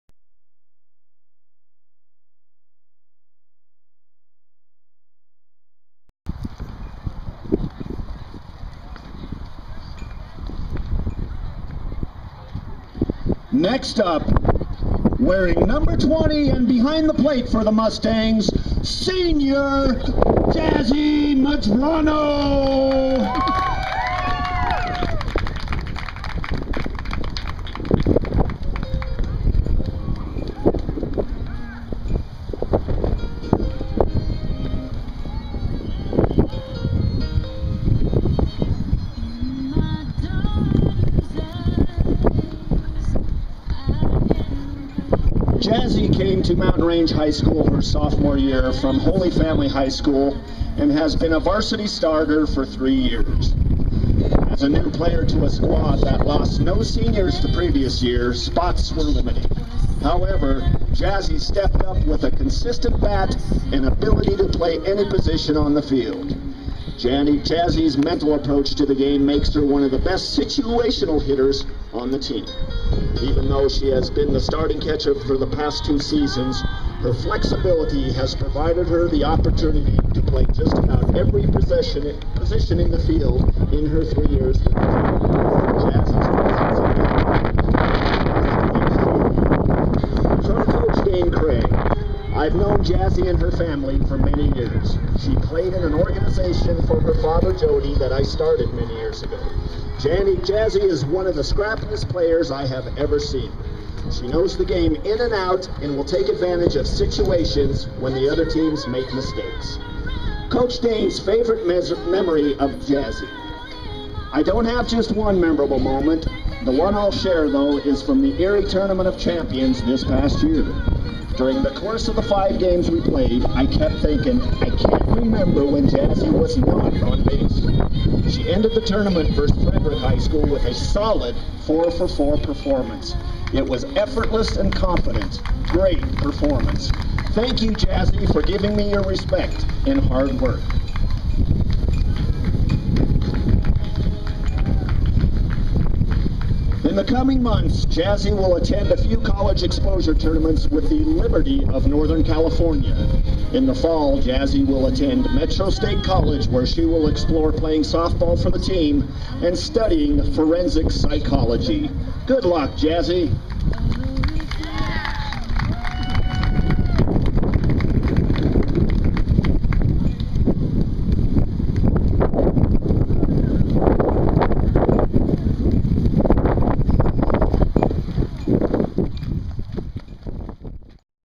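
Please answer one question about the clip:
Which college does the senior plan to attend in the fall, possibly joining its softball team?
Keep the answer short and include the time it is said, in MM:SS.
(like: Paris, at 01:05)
Metro State College, at 02:35.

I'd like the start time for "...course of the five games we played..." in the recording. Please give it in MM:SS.
02:01.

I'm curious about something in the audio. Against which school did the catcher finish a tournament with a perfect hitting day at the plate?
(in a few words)
Frederick High School.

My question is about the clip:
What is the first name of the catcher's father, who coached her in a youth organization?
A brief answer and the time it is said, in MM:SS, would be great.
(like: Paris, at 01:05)
Jody, at 01:37.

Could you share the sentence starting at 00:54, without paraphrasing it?
As a new player to a squad that lost no seniors the previous year, spots were limited.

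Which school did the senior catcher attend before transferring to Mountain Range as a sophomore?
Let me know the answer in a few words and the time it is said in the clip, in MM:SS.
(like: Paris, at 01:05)
Holy Family High School, at 00:48.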